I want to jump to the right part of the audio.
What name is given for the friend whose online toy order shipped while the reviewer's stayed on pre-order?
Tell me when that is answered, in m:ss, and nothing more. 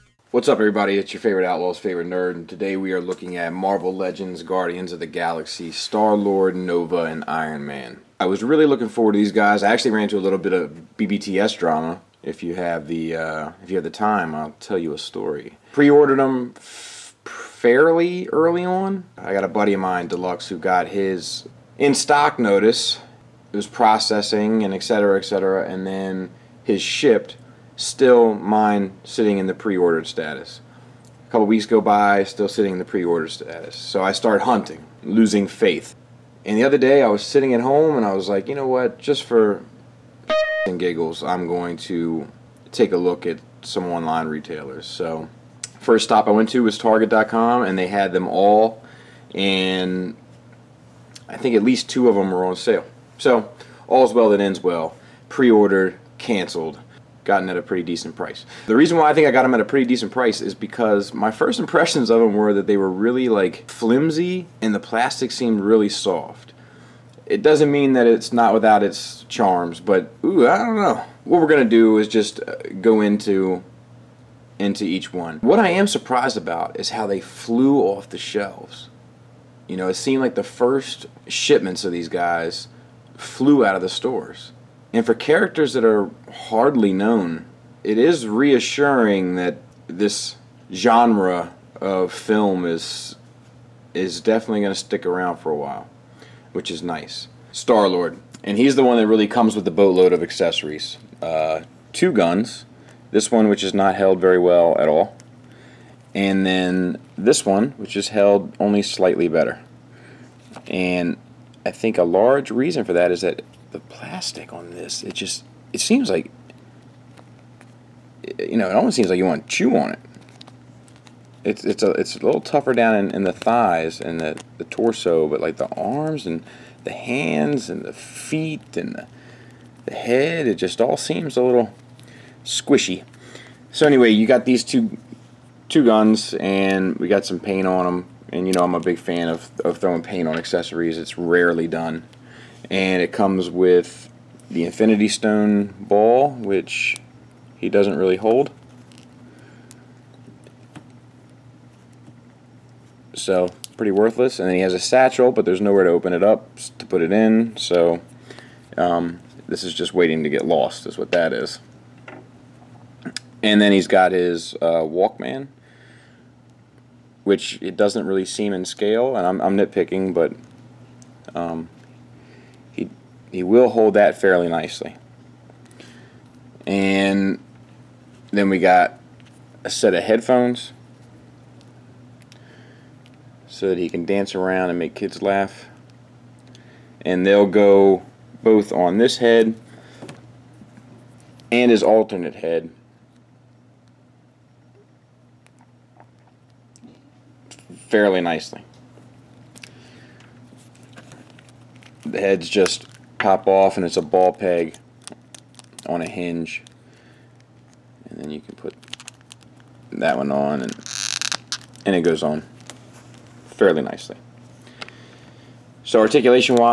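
0:20.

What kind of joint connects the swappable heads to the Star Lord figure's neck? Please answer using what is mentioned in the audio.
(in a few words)
ball peg on a hinge.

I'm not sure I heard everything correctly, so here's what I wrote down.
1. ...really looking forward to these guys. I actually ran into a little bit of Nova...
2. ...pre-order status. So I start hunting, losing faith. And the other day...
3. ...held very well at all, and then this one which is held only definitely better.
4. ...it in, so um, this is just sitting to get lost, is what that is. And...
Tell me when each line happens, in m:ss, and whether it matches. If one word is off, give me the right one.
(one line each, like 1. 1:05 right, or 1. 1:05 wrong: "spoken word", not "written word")
1. 0:08 wrong: "BBTS", not "Nova"
2. 0:32 right
3. 1:43 wrong: "slightly", not "definitely"
4. 2:37 wrong: "waiting", not "sitting".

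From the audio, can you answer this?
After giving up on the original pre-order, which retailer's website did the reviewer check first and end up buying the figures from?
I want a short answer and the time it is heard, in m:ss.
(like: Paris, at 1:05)
Target.com, at 0:46.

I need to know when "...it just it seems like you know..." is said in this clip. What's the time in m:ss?
1:55.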